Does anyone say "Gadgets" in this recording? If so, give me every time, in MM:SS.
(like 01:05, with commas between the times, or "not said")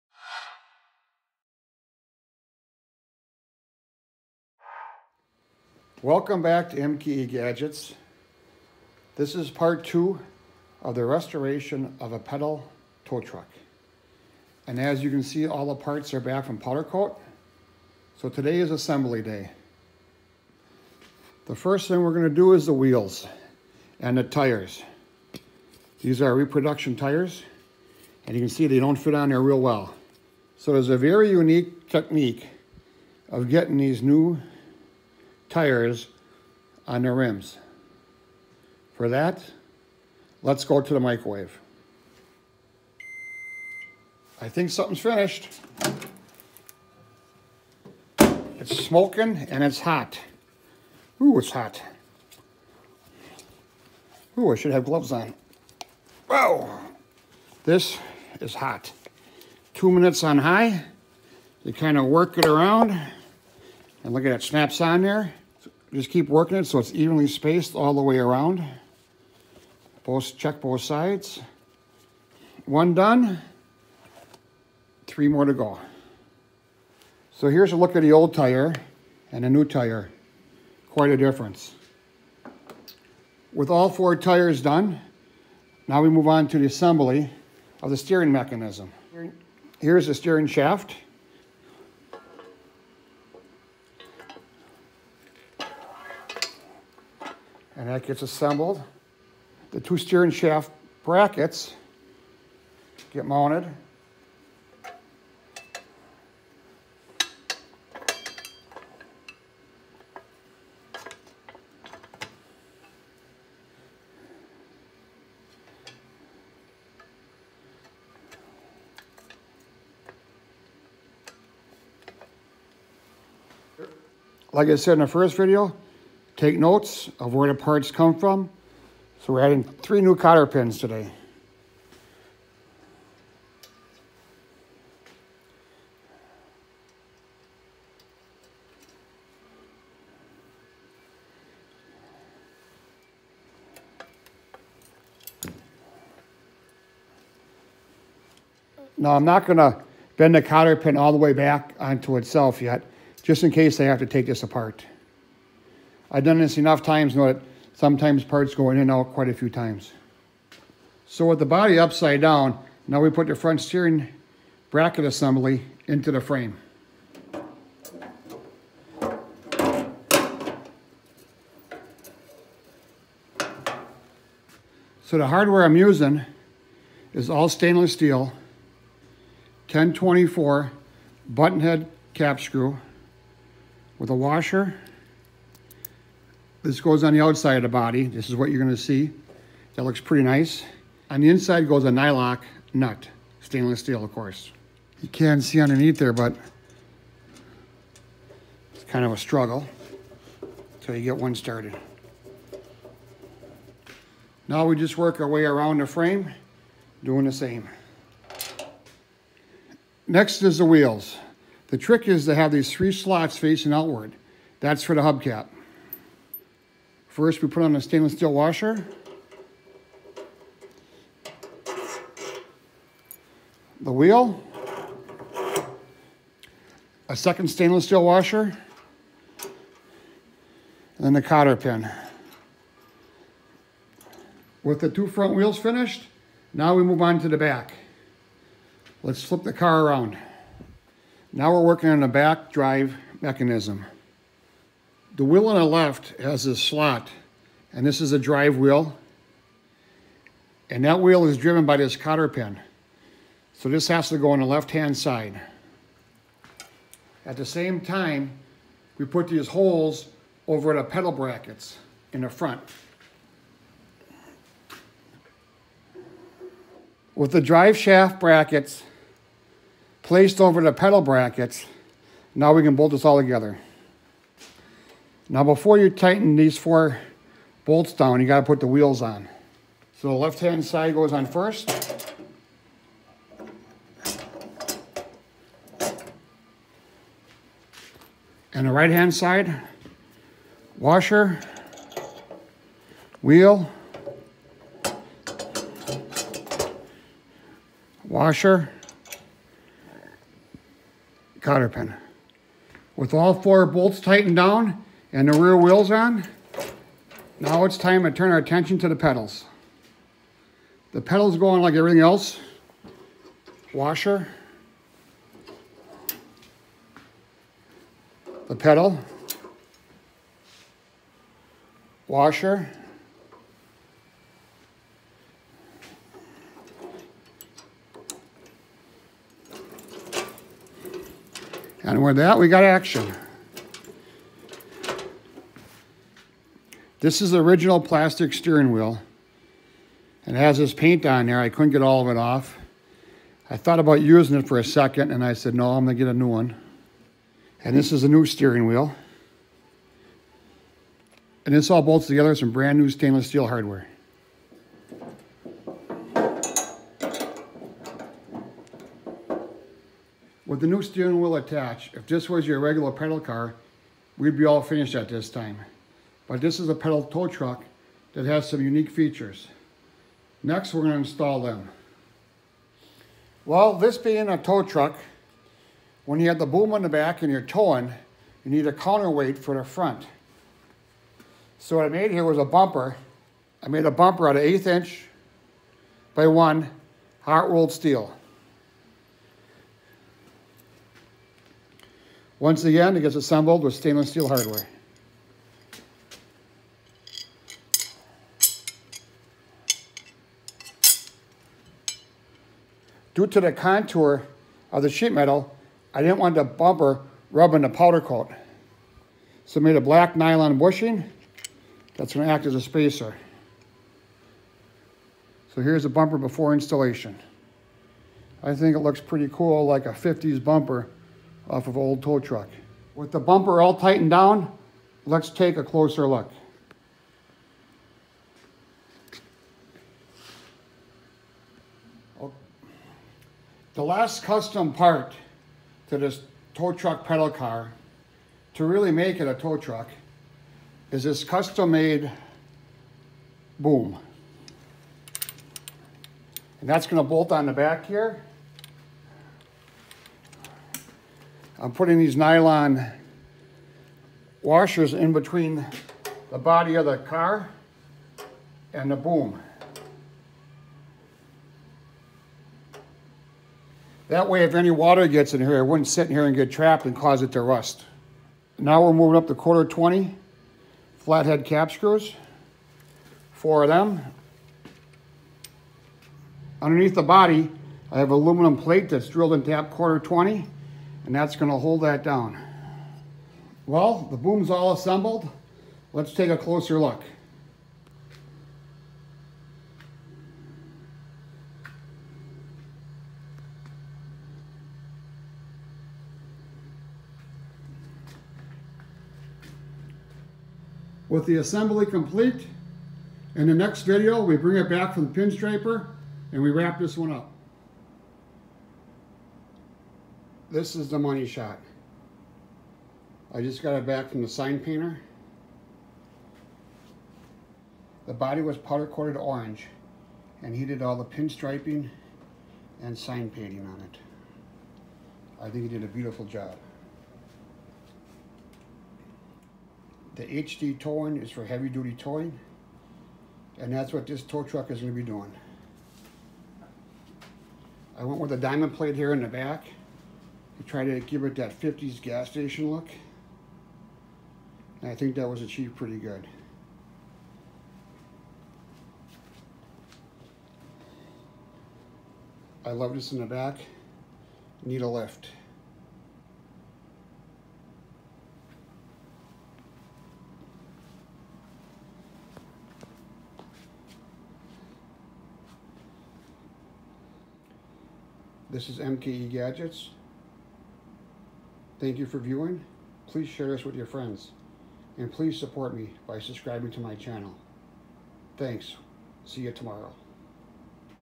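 00:07, 09:29.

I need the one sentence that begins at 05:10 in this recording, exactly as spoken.
The pedals go on like everything else.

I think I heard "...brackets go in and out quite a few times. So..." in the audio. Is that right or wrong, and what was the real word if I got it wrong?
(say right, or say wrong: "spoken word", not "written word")
wrong: "parts", not "brackets".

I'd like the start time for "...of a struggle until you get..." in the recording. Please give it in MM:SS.
03:19.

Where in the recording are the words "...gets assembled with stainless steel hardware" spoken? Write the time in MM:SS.
06:33.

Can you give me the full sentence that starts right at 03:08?
This is what you're gonna see.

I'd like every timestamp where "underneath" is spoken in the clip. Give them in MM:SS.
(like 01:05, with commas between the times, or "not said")
03:15, 07:56.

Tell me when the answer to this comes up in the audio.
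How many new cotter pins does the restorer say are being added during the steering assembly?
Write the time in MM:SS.
02:09.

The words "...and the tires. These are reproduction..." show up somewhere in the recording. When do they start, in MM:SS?
00:23.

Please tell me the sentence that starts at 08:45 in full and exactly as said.
I think he did a beautiful job.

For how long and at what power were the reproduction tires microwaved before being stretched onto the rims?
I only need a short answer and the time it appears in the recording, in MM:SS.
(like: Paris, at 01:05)
2 minutes on high, at 00:59.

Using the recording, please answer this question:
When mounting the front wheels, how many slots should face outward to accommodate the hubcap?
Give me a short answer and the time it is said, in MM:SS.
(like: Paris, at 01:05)
3, at 03:32.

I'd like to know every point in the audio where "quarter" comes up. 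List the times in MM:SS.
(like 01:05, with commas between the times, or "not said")
07:49, 07:59.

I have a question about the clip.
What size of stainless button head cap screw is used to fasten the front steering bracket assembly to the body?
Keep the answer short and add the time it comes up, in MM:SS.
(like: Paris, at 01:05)
10-24, at 02:59.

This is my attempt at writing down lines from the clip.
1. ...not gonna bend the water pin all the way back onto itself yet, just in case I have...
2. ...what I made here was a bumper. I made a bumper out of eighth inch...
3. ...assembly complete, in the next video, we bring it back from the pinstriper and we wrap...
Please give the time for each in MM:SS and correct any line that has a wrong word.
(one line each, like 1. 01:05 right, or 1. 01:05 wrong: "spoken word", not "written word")
1. 02:29 wrong: "cotter", not "water"
2. 06:21 right
3. 08:21 right.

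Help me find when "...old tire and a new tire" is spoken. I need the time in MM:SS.
01:18.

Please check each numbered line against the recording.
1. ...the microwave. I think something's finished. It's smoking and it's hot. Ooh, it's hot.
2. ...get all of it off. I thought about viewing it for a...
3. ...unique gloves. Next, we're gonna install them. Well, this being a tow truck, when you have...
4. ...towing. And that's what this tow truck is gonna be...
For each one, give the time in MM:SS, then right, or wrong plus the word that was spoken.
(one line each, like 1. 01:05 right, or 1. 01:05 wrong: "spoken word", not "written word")
1. 00:40 right
2. 05:41 wrong: "using", not "viewing"
3. 06:08 wrong: "features", not "gloves"
4. 08:51 right.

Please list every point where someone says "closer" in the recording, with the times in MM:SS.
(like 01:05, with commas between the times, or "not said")
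07:05, 08:06.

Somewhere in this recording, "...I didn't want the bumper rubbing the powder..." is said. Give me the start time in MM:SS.
06:45.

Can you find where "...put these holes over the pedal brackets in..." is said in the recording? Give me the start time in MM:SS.
04:19.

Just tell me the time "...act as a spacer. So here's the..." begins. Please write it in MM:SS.
06:52.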